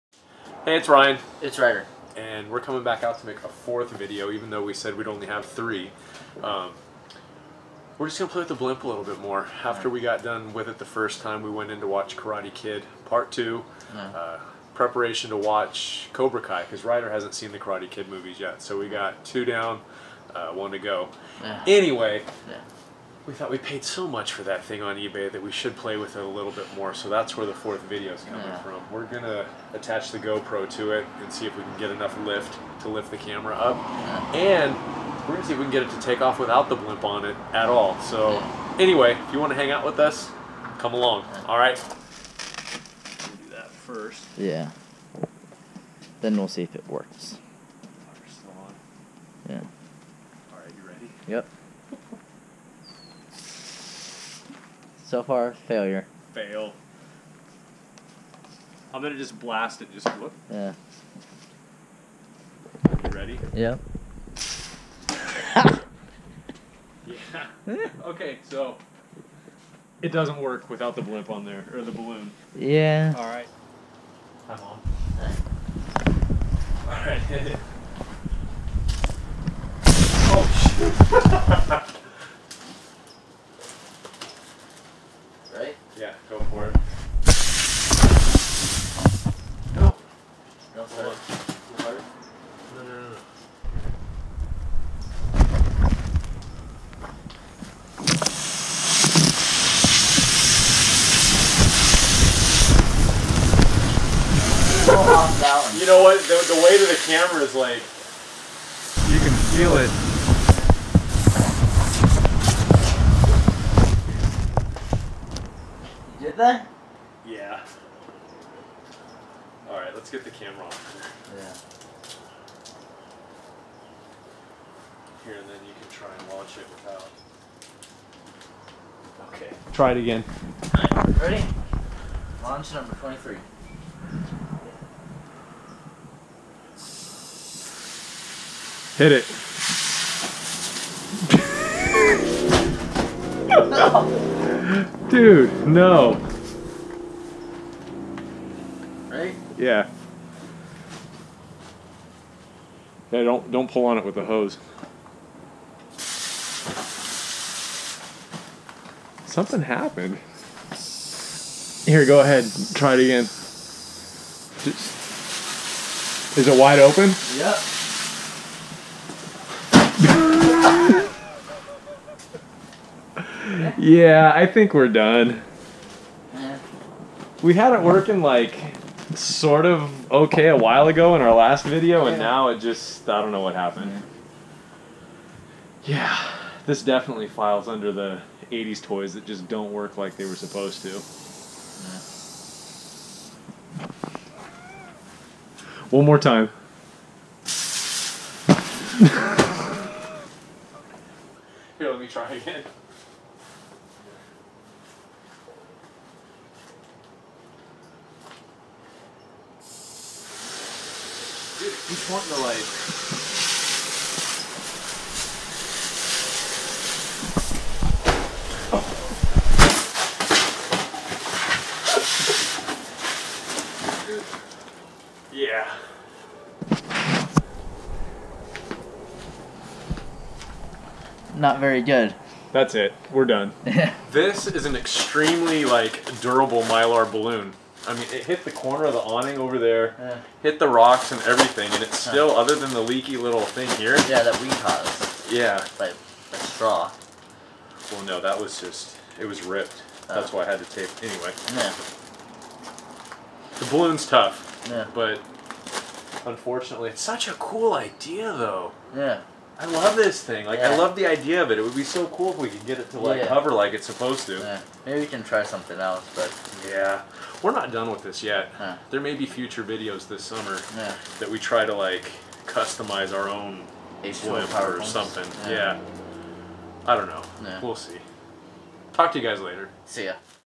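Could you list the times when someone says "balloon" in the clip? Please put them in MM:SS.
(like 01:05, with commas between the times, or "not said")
01:11, 03:57, 04:13.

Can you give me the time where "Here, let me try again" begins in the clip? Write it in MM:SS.
03:21.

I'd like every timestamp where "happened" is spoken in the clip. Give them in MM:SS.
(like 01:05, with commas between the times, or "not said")
02:39, 03:03.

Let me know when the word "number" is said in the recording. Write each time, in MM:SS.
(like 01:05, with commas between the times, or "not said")
02:12.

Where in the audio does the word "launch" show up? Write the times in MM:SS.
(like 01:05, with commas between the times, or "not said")
02:06, 02:12.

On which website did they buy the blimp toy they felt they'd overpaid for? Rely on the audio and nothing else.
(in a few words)
eBay.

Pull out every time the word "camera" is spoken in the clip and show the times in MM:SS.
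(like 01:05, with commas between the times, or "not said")
00:33, 01:47, 02:00.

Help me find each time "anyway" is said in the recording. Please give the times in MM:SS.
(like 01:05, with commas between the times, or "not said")
00:21, 00:38, 04:11.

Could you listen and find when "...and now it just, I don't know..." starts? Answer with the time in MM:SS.
03:02.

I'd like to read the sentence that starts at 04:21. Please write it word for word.
It would be so cool if we could get it to like yeah.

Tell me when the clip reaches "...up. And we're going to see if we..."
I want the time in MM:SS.
00:33.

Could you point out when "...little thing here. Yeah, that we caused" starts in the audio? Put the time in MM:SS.
04:03.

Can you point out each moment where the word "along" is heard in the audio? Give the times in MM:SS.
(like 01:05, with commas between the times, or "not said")
00:40.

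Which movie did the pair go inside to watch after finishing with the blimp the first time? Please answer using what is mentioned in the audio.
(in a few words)
Karate Kid Part 2.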